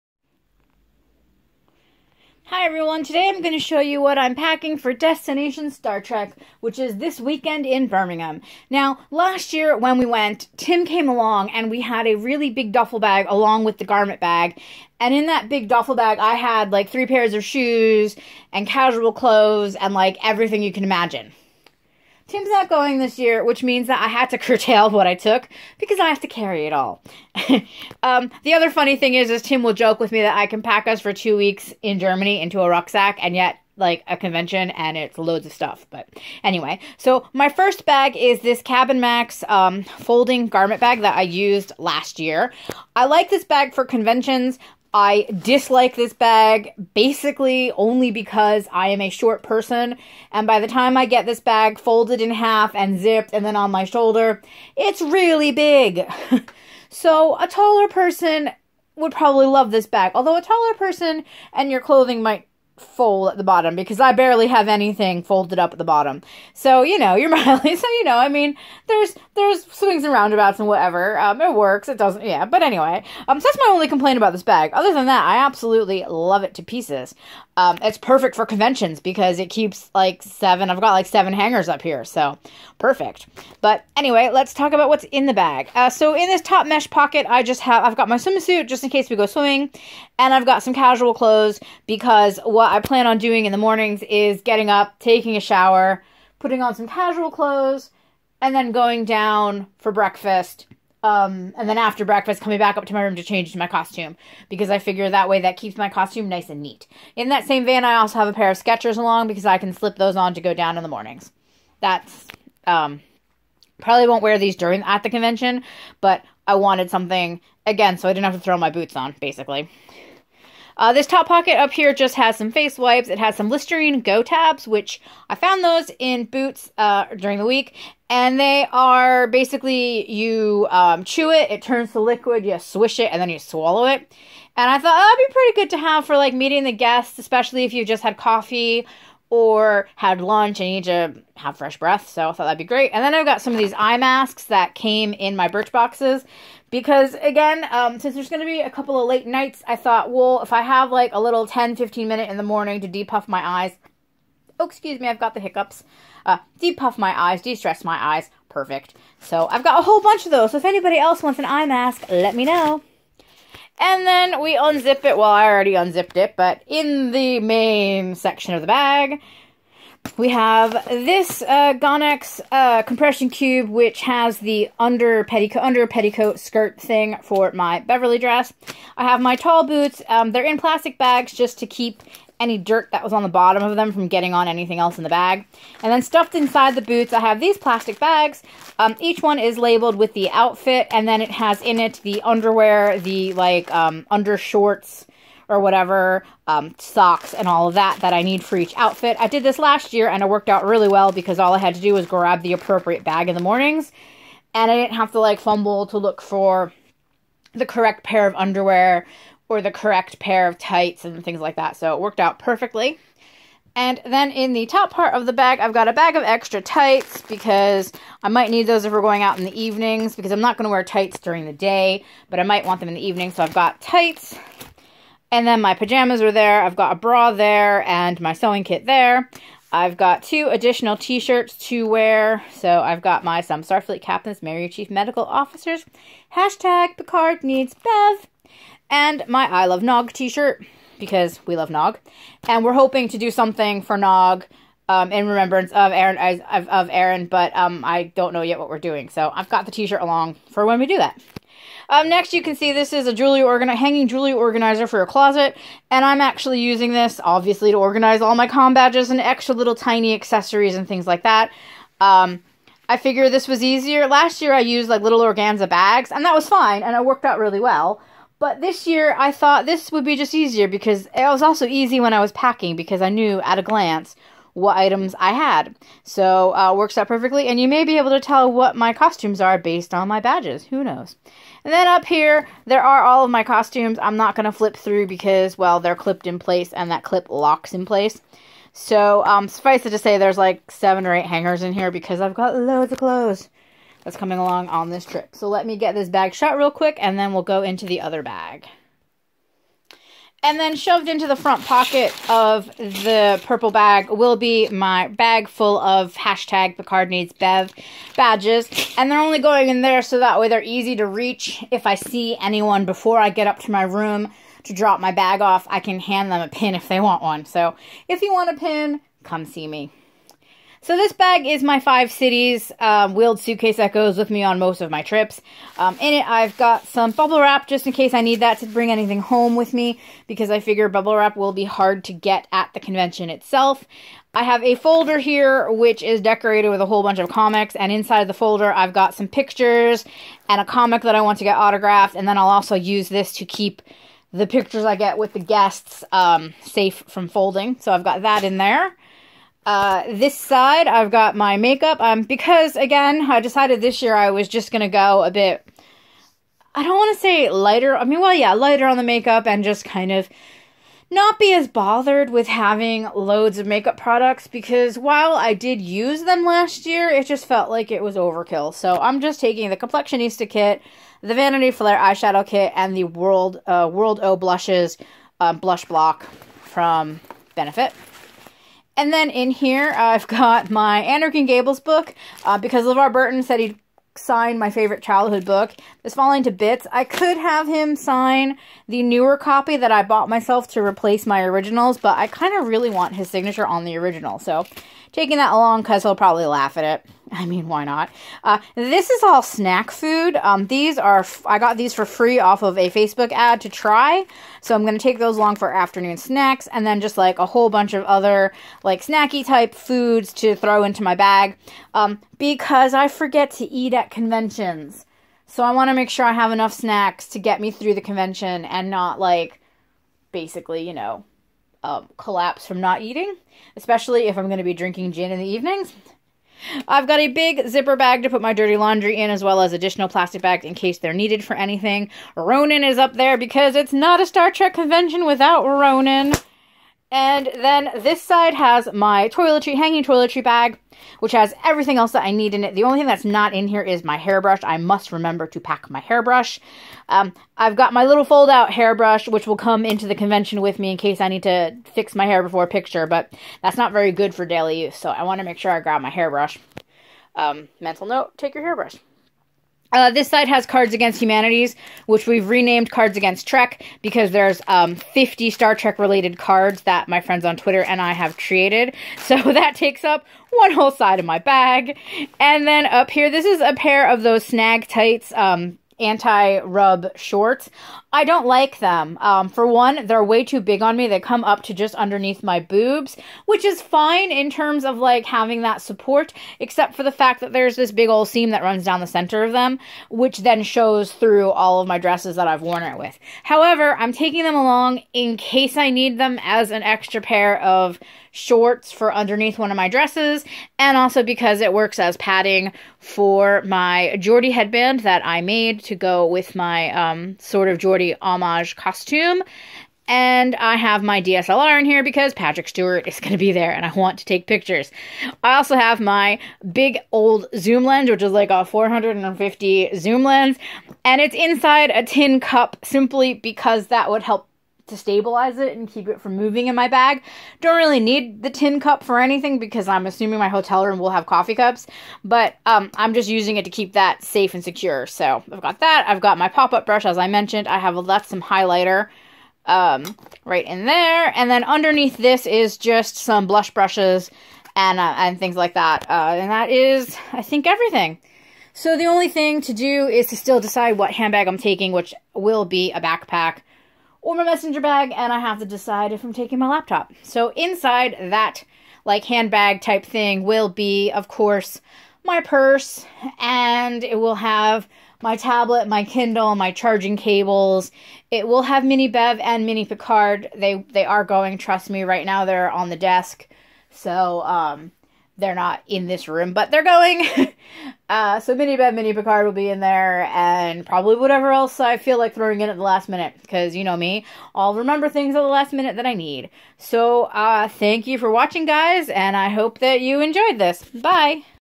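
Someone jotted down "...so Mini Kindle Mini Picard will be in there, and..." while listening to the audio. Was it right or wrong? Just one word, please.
wrong.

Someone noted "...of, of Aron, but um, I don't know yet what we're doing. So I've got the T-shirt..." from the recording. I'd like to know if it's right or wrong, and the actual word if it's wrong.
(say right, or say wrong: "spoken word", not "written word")
right.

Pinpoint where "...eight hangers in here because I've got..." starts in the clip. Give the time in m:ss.
4:51.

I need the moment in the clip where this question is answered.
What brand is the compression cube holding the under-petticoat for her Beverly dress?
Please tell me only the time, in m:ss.
2:51.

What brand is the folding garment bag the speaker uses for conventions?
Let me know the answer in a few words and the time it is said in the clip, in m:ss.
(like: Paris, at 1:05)
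Cabin Max, at 0:38.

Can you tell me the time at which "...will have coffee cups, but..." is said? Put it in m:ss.
8:50.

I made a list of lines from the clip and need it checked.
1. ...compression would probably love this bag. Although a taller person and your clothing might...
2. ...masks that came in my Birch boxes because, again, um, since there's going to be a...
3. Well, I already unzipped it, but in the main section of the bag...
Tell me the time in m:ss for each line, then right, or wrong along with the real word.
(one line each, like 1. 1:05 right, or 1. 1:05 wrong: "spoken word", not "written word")
1. 0:57 wrong: "person", not "compression"
2. 2:23 right
3. 2:45 right.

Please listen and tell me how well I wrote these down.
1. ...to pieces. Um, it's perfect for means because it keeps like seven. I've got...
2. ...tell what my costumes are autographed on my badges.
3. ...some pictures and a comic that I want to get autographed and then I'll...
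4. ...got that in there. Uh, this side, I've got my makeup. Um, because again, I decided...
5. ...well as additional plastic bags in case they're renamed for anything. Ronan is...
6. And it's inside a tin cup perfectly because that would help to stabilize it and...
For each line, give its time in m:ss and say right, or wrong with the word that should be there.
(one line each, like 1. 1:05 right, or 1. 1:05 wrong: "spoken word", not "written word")
1. 1:16 wrong: "conventions", not "means"
2. 4:38 wrong: "based", not "autographed"
3. 5:39 right
4. 5:48 right
5. 7:09 wrong: "needed", not "renamed"
6. 8:41 wrong: "simply", not "perfectly".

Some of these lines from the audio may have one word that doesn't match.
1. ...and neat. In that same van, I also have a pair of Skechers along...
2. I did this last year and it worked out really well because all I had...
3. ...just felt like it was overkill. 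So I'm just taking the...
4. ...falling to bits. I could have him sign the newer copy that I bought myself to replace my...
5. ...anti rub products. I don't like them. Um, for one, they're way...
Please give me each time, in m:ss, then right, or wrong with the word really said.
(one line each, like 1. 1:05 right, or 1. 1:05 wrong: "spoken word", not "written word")
1. 1:46 right
2. 3:19 right
3. 6:07 right
4. 6:26 right
5. 7:55 wrong: "shorts", not "products".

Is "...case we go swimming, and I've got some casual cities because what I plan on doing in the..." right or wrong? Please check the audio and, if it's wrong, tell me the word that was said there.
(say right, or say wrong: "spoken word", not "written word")
wrong: "clothes", not "cities".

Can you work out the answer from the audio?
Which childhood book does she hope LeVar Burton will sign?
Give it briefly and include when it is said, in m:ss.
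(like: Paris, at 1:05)
Anne of Green Gables, at 6:21.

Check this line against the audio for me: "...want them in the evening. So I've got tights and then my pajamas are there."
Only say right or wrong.
right.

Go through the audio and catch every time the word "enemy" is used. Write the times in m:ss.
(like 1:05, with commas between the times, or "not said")
not said.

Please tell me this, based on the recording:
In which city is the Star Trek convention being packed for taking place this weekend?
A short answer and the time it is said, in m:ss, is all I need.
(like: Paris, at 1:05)
Birmingham, at 0:07.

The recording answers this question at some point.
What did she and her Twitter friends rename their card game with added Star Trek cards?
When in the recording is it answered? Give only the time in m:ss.
7:42.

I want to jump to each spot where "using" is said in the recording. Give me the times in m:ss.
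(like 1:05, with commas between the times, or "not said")
4:16, 8:53.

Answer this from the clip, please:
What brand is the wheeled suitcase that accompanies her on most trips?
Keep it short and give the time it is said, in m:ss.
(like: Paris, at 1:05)
Five Cities, at 5:21.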